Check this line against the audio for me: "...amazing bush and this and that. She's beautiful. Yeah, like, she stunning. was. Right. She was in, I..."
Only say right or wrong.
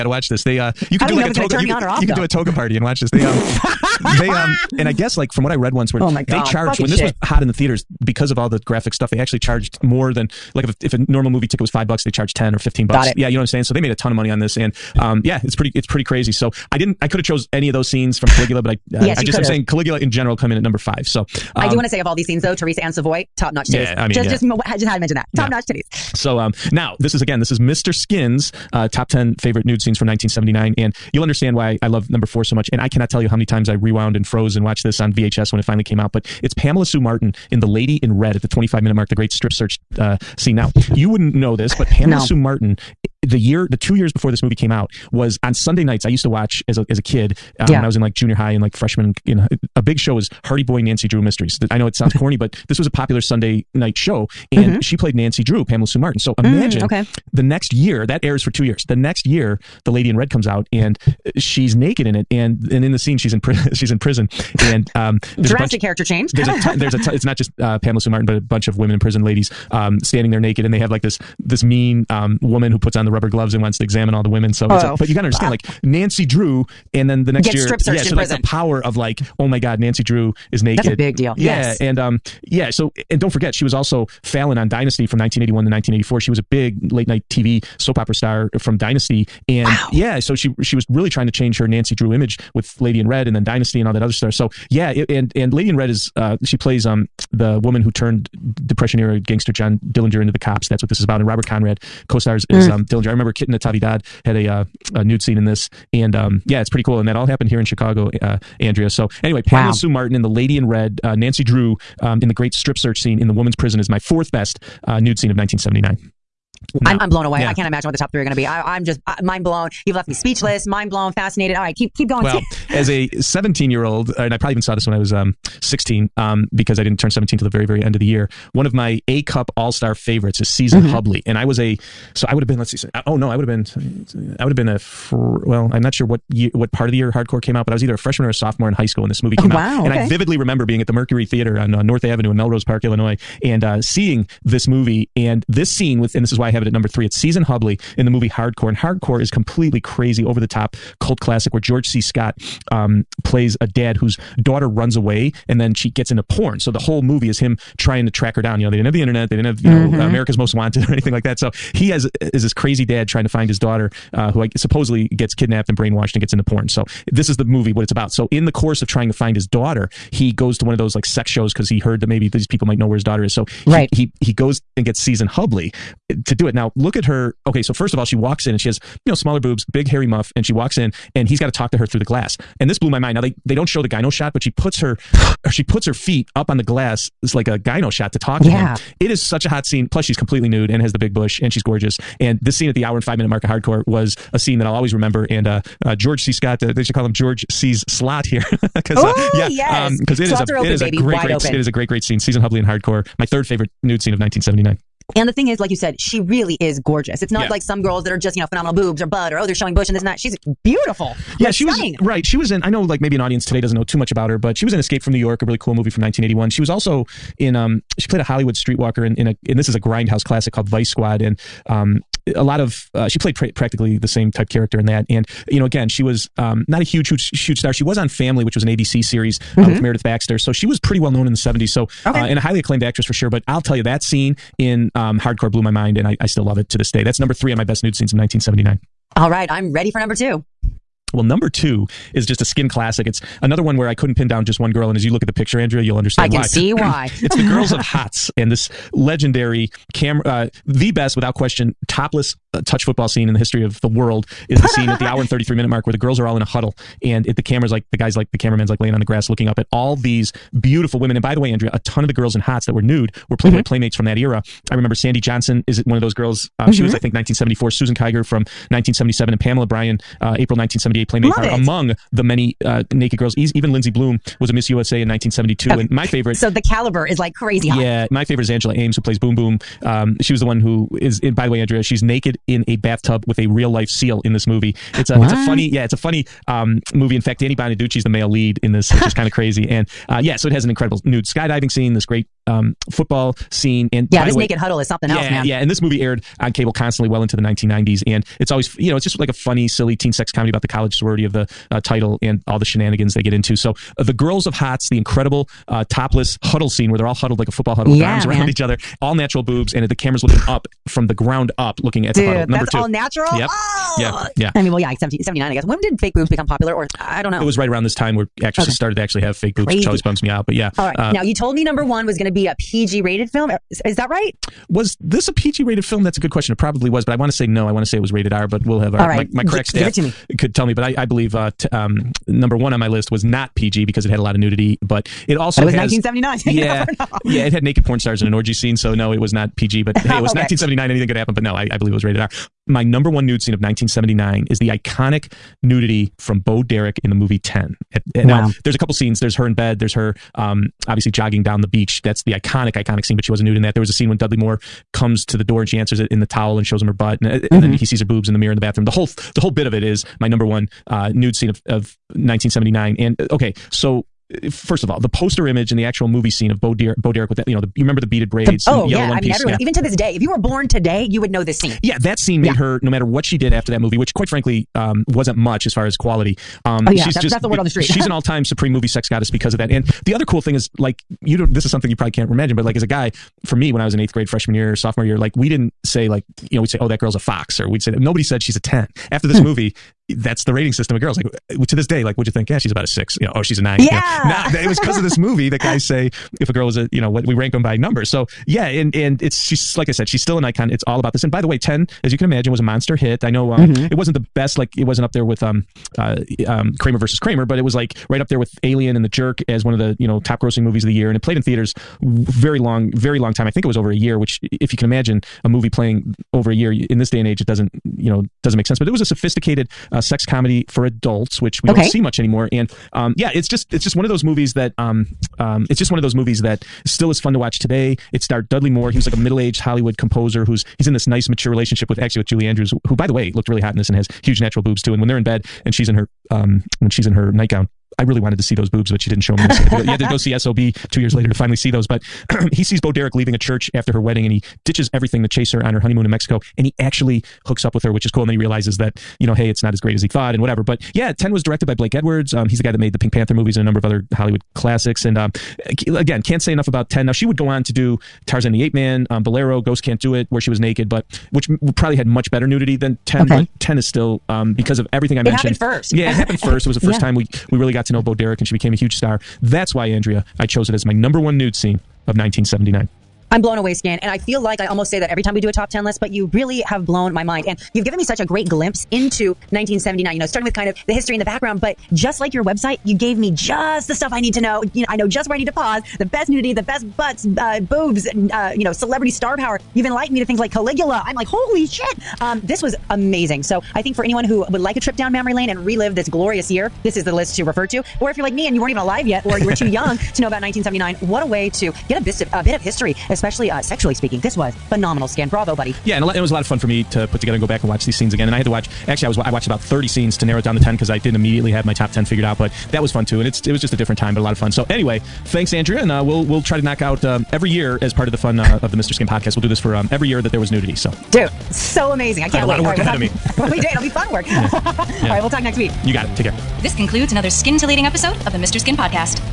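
wrong.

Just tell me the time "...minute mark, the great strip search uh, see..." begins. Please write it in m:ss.
0:38.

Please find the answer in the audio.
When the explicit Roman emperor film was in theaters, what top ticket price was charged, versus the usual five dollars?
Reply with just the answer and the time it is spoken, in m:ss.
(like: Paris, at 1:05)
15 bucks, at 0:12.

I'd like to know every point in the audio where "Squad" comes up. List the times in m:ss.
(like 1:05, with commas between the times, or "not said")
3:40.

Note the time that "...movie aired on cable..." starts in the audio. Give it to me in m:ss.
4:55.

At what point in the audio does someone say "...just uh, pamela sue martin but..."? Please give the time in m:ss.
1:07.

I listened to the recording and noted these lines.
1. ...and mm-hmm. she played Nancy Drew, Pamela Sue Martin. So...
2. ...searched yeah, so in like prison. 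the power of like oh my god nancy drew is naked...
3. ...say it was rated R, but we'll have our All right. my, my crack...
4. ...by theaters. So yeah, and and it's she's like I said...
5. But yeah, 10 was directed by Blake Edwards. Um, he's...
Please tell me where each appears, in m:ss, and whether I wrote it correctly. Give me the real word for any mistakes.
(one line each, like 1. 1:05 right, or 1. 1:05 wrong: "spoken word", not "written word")
1. 0:54 right
2. 1:17 right
3. 5:27 right
4. 6:37 wrong: "numbers", not "theaters"
5. 7:30 right.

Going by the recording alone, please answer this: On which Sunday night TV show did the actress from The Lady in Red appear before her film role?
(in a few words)
Hardy Boy Nancy Drew Mysteries.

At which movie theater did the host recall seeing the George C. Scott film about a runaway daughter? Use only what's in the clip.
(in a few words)
Mercury Theater.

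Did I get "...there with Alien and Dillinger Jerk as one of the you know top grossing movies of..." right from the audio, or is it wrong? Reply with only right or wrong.
wrong.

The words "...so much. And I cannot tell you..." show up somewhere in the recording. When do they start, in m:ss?
0:32.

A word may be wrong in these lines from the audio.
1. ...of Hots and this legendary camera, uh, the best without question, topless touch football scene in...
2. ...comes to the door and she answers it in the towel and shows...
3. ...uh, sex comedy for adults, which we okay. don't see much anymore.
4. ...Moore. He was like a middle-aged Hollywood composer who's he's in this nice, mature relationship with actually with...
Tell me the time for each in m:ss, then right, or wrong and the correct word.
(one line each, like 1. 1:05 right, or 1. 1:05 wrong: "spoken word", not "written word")
1. 4:07 right
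2. 5:54 right
3. 6:59 right
4. 7:08 right.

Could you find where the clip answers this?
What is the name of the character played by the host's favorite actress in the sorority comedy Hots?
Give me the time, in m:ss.
4:39.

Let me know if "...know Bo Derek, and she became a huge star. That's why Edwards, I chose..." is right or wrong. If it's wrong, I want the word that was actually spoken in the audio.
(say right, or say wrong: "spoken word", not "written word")
wrong: "Andrea", not "Edwards".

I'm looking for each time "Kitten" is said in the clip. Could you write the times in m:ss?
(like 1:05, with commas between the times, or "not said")
1:43.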